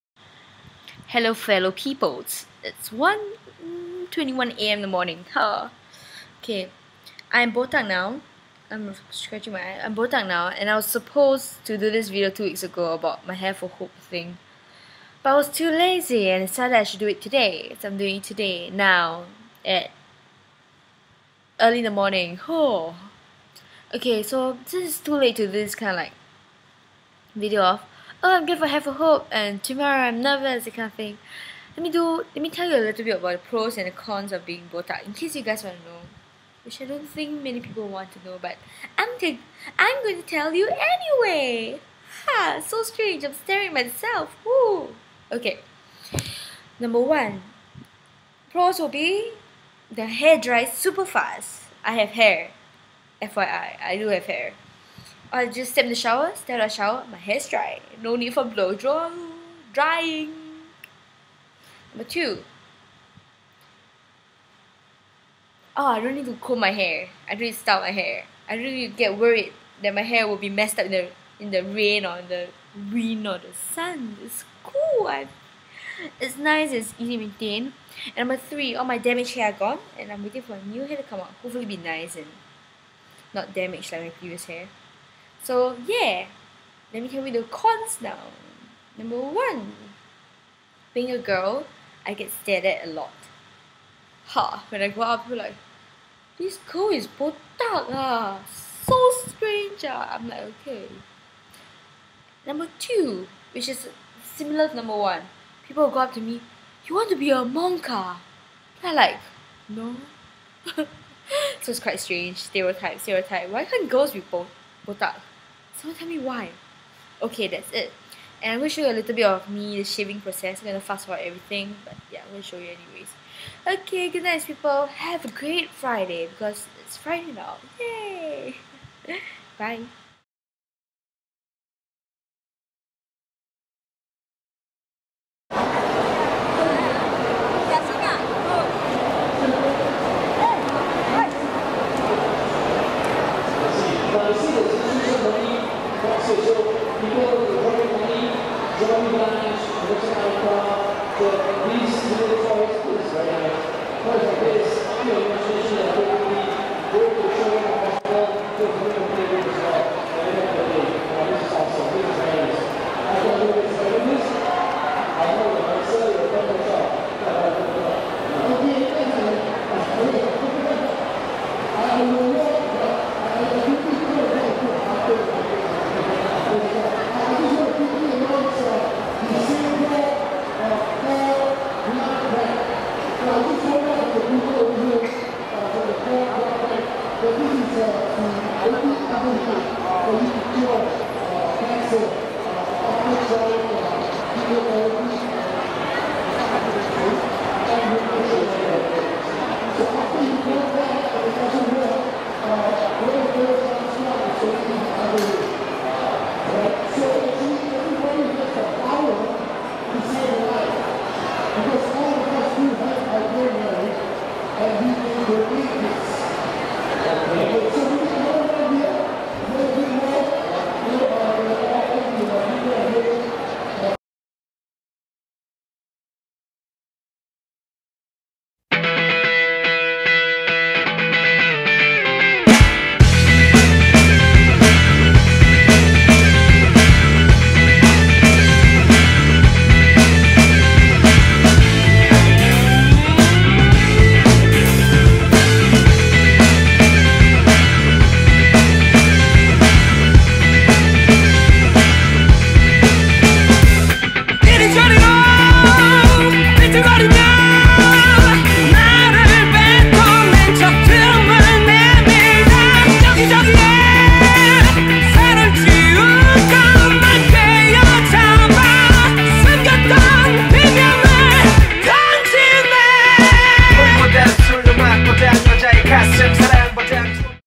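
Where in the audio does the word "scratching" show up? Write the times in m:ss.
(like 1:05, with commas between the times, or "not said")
0:09.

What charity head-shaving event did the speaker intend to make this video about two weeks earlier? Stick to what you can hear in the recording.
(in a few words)
Hair for Hope.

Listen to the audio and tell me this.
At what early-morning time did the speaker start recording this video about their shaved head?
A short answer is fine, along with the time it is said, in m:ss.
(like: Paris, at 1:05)
1:21 a.m., at 0:02.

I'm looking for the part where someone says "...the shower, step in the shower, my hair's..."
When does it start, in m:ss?
0:55.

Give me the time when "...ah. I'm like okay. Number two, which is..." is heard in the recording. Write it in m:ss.
1:39.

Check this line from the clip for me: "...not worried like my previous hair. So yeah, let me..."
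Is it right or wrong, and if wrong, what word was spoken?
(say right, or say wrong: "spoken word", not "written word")
wrong: "damaged", not "worried".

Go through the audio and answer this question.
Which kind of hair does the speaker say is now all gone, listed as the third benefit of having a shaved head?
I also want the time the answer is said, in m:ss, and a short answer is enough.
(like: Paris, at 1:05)
damaged hair, at 1:18.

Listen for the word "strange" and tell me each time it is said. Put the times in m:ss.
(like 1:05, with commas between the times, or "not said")
0:42, 1:39, 1:51.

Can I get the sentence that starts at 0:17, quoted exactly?
So I'm doing it today, now, at early in the morning.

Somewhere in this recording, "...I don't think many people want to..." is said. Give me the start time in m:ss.
0:36.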